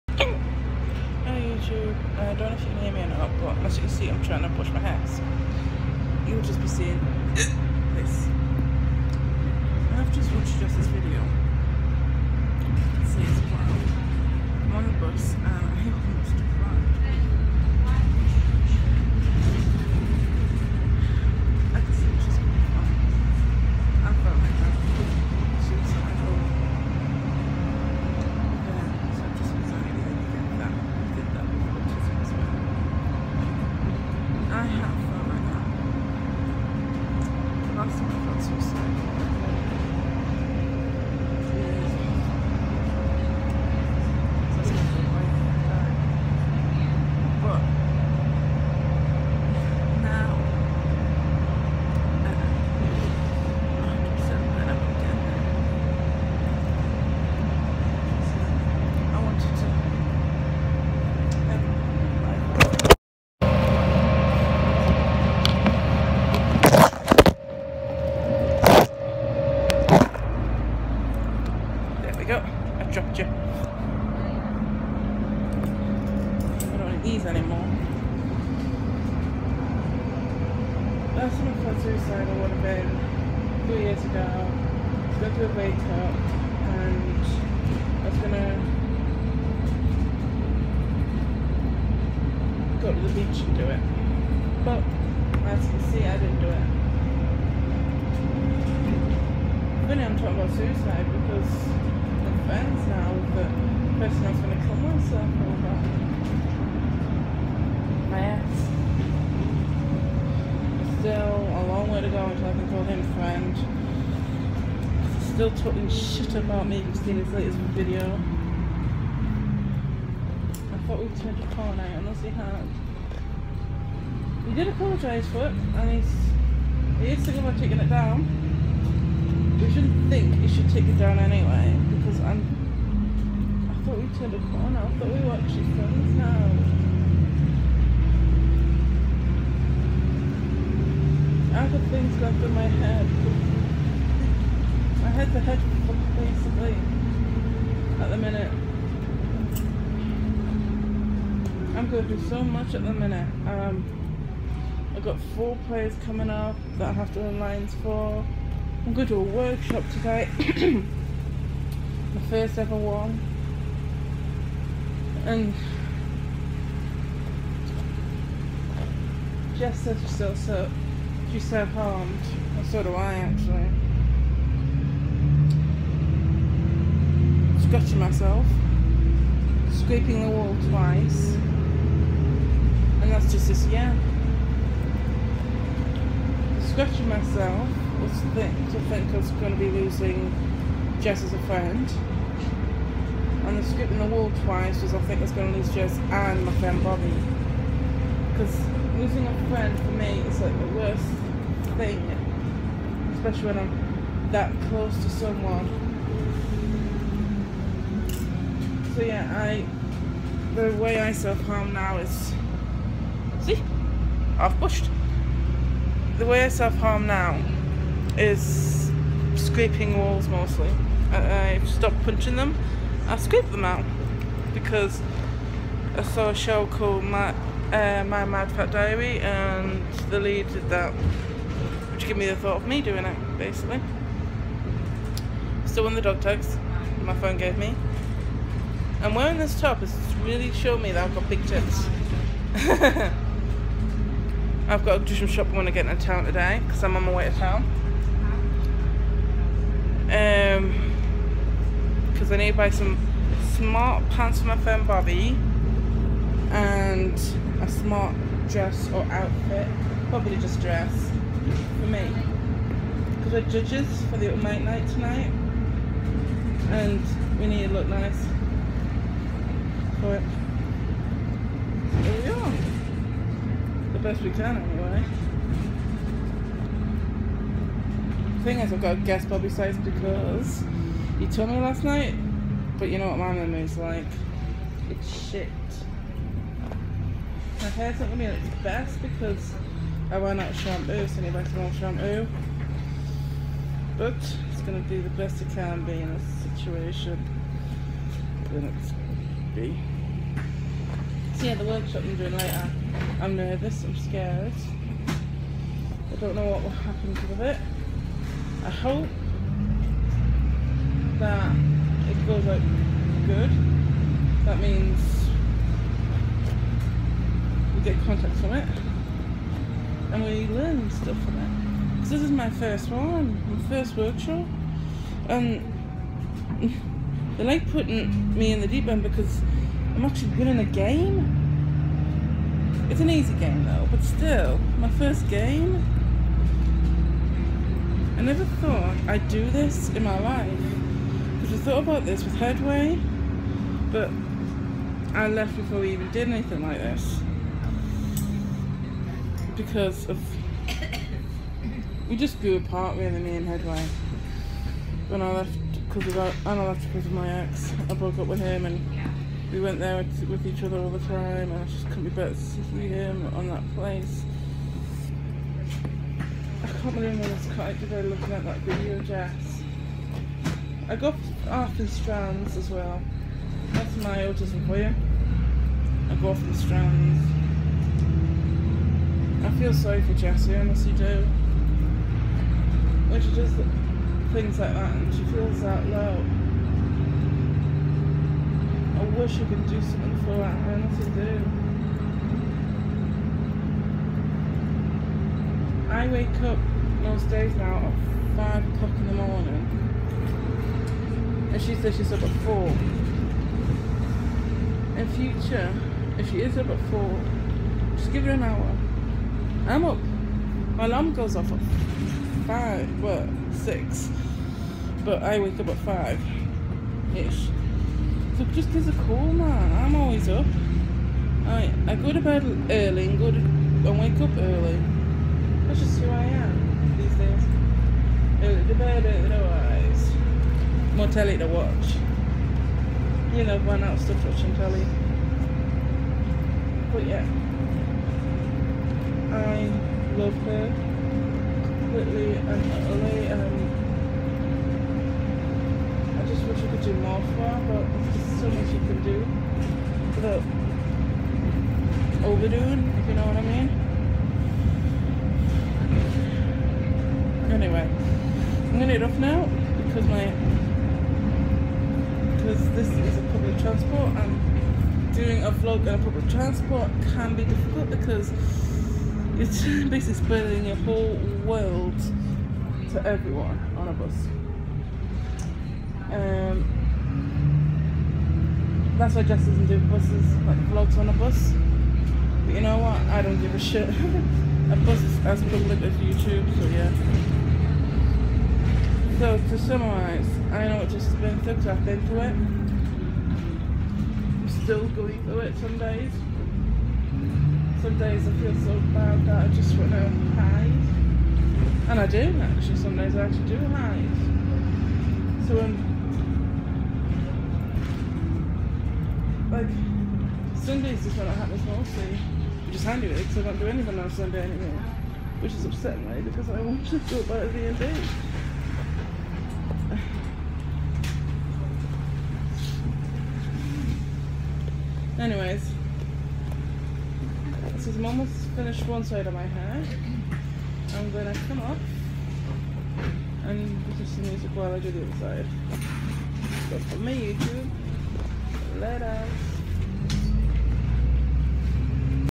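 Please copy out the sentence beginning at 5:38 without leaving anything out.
I never thought I'd do this in my life.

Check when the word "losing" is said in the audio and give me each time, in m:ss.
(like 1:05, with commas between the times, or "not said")
3:09, 3:18.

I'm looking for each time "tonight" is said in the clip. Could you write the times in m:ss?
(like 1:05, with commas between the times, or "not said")
4:24.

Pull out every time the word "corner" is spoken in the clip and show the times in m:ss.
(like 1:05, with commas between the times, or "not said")
2:01, 2:14.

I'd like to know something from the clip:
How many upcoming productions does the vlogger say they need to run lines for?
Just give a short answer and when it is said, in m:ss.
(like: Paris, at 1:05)
4, at 2:35.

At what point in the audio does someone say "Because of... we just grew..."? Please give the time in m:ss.
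5:49.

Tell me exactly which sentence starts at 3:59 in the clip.
It's really showing me that I've got big tits.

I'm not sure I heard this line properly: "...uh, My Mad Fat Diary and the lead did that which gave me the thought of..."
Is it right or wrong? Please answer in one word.
right.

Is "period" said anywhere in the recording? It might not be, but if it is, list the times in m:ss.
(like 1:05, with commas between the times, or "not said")
not said.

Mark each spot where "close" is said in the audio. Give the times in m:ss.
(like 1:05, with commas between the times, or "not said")
3:24.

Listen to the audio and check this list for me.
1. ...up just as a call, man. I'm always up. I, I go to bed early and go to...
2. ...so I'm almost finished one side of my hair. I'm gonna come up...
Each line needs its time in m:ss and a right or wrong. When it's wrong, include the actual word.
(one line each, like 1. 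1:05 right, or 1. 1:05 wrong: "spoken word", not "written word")
1. 6:58 right
2. 8:47 right.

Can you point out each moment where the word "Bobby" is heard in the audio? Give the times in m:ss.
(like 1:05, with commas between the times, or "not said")
3:16, 4:14, 4:39.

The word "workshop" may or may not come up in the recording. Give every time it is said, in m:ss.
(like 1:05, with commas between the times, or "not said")
2:39, 5:01, 5:23.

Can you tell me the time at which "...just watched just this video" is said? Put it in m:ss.
0:10.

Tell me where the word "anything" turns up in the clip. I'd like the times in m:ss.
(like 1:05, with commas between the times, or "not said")
5:46, 8:33.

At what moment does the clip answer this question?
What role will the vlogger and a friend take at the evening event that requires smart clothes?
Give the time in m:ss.
4:23.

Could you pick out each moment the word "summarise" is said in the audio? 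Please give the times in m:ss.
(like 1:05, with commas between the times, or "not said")
8:09.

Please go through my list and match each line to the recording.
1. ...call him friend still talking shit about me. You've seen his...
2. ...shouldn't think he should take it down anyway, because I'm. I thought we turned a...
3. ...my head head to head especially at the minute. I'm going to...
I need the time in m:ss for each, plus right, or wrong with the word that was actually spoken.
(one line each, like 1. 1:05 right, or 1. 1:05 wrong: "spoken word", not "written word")
1. 1:52 right
2. 2:09 right
3. 2:22 wrong: "basically", not "especially".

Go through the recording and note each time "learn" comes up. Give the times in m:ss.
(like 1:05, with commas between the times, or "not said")
5:20.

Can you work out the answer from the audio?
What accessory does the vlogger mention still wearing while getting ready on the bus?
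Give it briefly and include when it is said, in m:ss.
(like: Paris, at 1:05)
dog tags, at 3:56.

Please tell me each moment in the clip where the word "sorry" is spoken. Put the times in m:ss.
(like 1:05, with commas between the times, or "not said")
6:19.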